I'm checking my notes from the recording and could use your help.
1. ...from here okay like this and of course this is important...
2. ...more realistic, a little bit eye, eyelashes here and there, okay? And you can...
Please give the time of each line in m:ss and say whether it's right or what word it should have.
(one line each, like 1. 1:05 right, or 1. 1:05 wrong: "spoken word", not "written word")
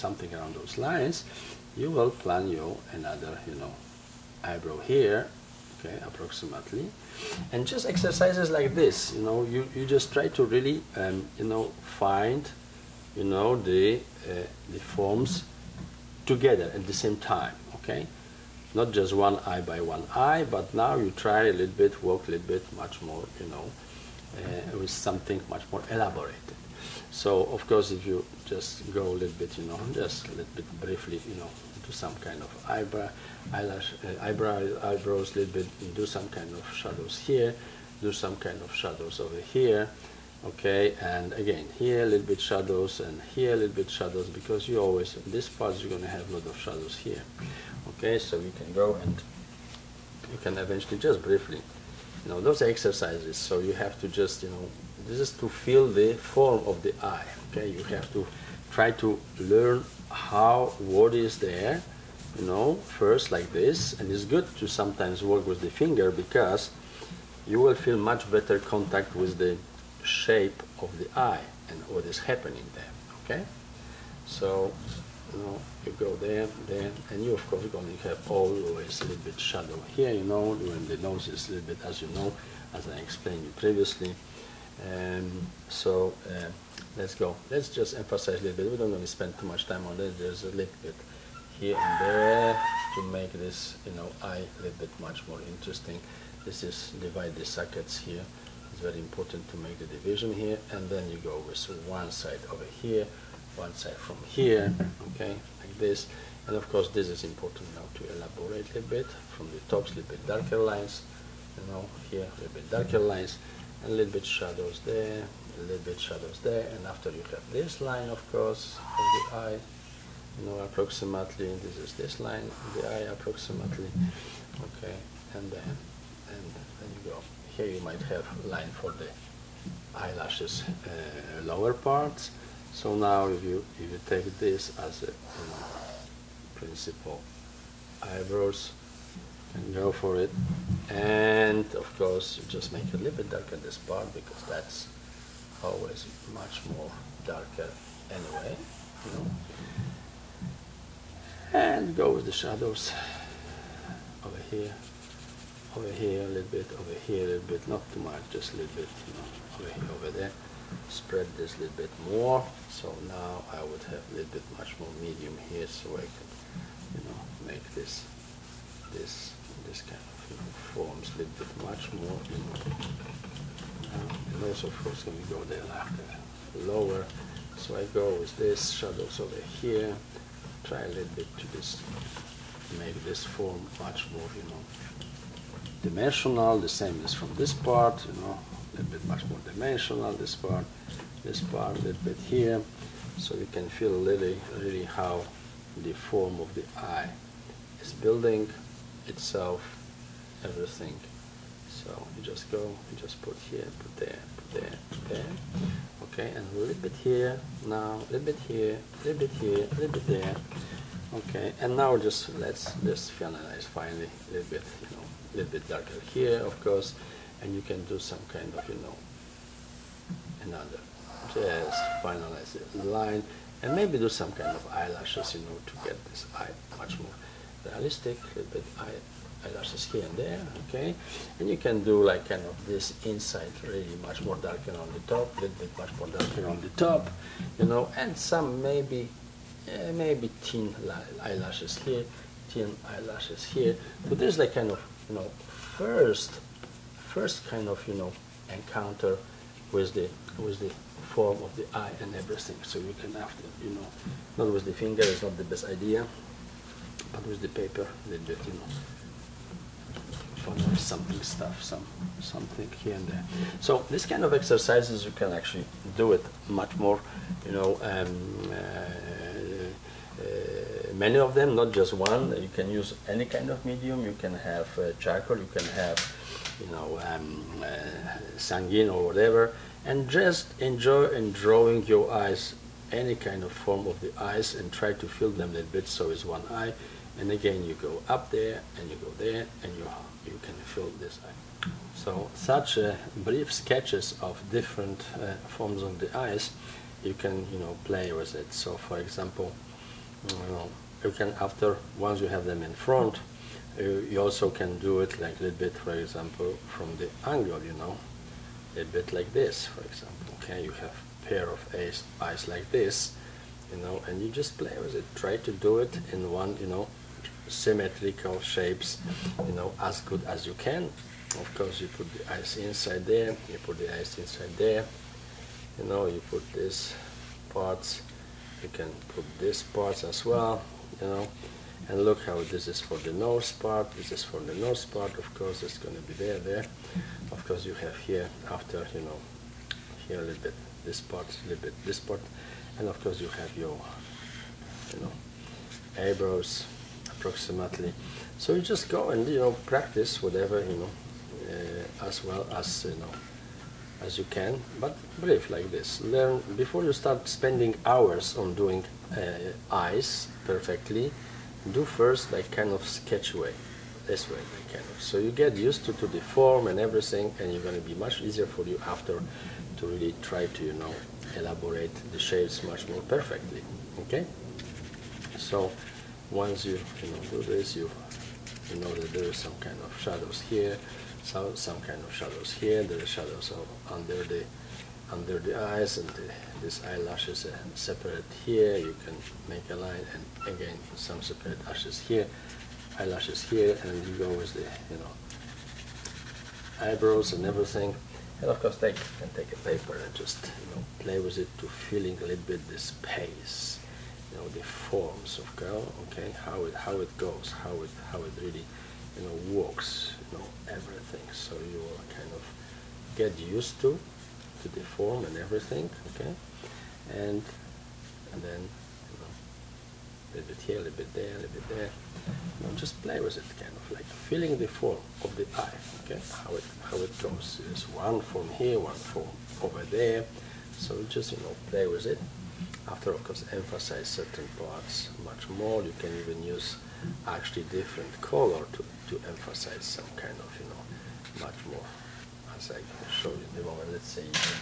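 1. 1:44 right
2. 3:47 right.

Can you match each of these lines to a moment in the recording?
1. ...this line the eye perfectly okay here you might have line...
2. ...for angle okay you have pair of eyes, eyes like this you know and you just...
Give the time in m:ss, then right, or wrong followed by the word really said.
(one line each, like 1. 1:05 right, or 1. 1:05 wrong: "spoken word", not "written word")
1. 2:01 wrong: "approximately", not "perfectly"
2. 5:09 wrong: "example", not "angle".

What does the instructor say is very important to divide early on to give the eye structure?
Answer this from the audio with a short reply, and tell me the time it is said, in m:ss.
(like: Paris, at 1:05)
the sockets, at 1:37.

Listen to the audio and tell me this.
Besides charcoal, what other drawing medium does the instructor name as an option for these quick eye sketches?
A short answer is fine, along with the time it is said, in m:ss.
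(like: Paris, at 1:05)
sanguine, at 4:38.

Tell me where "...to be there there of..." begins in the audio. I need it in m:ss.
5:35.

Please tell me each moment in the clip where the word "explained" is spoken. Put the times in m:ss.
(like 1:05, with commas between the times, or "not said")
1:22.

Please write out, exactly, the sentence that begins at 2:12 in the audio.
So now if you, if you take this as a principle, principal eyebrows and go for it.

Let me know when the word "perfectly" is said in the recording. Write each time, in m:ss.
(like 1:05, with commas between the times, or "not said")
6:00, 6:13.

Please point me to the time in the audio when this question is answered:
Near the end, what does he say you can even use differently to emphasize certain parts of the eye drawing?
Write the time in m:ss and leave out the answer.
7:17.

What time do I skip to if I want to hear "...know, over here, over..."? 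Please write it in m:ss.
2:39.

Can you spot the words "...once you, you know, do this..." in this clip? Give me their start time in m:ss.
6:16.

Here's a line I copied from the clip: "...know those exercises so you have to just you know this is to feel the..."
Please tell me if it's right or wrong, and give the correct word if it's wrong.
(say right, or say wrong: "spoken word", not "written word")
right.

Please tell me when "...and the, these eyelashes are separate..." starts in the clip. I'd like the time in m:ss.
6:25.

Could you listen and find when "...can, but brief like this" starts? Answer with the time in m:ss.
5:54.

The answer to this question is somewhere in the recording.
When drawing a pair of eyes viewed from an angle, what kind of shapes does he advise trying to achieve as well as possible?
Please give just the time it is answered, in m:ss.
5:17.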